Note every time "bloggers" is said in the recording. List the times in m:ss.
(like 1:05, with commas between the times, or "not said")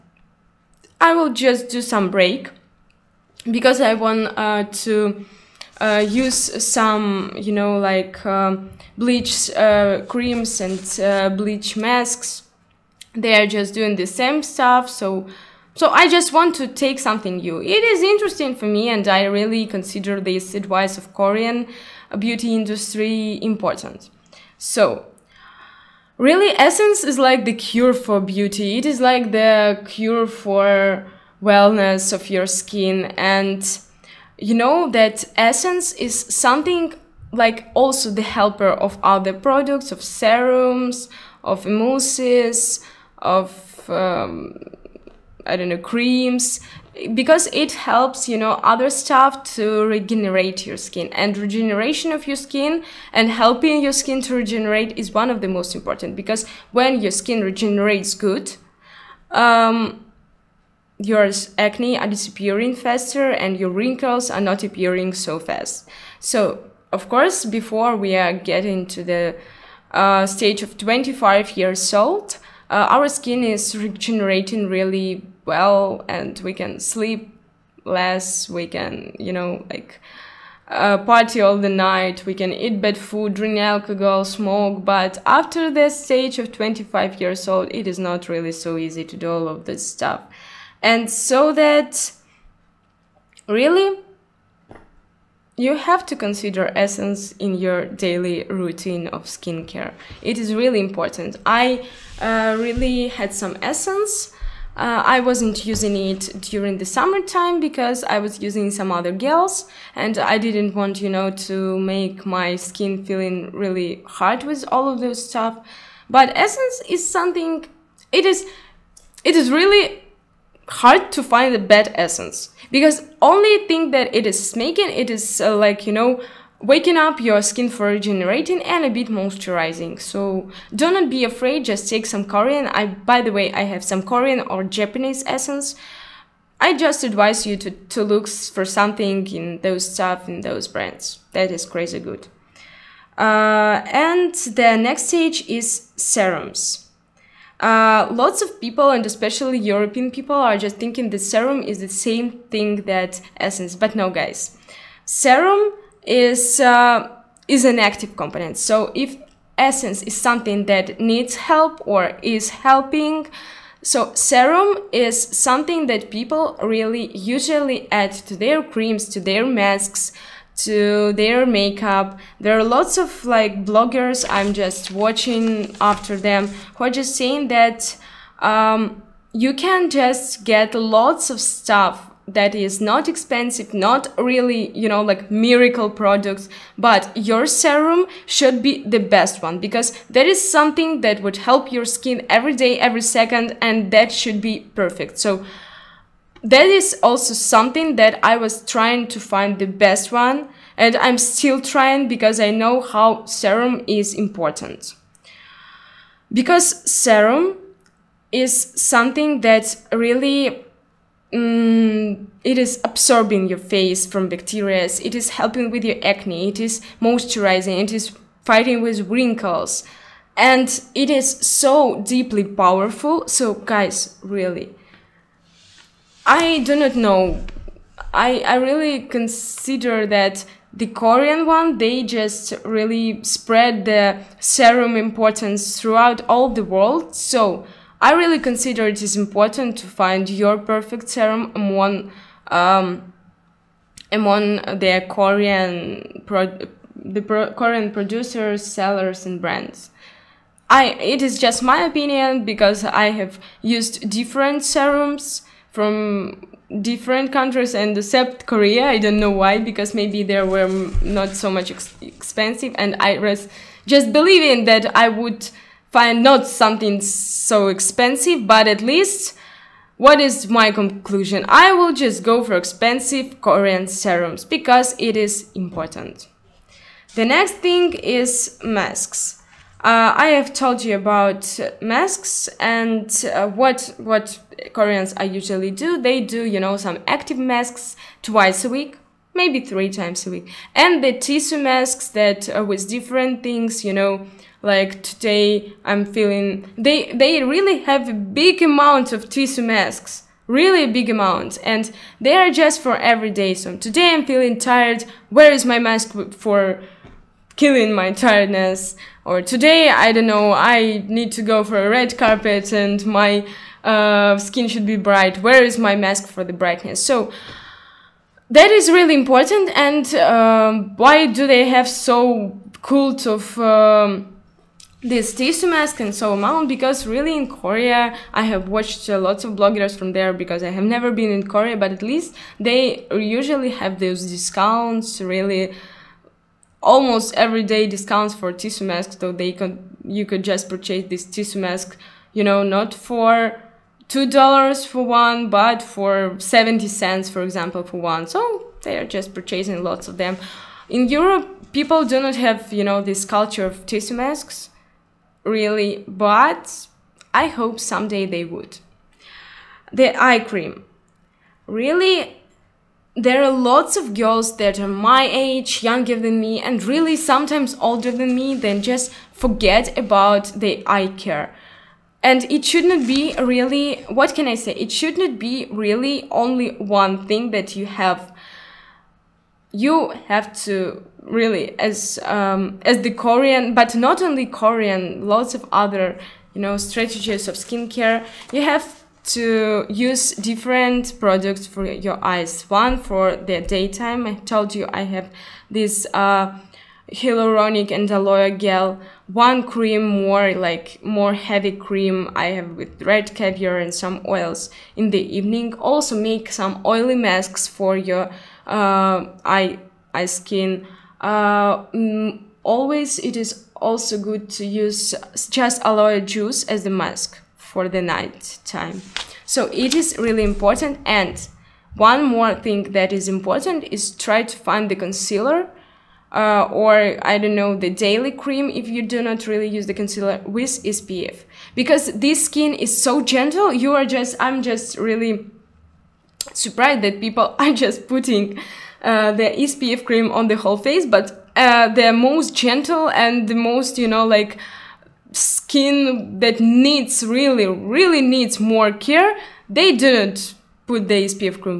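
2:53, 5:29.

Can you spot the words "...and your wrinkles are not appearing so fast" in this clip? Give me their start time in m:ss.
1:03.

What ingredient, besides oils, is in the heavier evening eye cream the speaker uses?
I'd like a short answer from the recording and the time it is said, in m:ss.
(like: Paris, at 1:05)
red caviar, at 6:43.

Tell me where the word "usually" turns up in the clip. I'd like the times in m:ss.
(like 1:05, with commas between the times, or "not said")
2:47, 4:45, 5:33.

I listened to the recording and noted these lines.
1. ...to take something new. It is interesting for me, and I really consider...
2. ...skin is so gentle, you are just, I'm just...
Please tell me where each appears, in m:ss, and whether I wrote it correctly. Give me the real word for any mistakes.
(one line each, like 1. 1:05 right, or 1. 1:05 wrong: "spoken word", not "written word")
1. 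0:16 right
2. 7:12 right.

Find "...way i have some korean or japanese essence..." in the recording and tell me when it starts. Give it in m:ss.
2:13.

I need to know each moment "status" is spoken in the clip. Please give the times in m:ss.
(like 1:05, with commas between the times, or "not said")
not said.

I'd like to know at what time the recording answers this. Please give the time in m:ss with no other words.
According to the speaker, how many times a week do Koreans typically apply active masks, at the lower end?
4:48.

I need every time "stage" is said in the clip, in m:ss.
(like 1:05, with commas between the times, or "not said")
1:10, 1:25, 2:25.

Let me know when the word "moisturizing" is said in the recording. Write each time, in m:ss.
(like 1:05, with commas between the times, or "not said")
2:09, 3:37.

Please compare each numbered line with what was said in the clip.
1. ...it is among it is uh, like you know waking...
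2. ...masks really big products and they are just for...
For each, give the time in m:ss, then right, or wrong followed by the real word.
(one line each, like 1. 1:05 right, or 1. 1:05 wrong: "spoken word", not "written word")
1. 2:04 wrong: "making", not "among"
2. 4:59 wrong: "amounts", not "products".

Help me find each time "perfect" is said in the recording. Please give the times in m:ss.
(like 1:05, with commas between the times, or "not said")
3:14, 4:00.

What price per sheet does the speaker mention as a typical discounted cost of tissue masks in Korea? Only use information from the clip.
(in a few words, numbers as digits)
70 cents.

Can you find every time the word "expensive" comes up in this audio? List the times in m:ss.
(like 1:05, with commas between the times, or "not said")
3:03, 4:22, 4:27, 4:32.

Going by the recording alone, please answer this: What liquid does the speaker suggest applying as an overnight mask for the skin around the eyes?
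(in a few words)
aloe juice.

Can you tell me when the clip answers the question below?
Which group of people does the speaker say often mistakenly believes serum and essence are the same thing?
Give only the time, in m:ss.
2:29.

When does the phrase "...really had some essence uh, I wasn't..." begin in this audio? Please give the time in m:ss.
1:42.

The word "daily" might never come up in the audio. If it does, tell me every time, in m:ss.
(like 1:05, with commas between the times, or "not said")
1:37, 7:07.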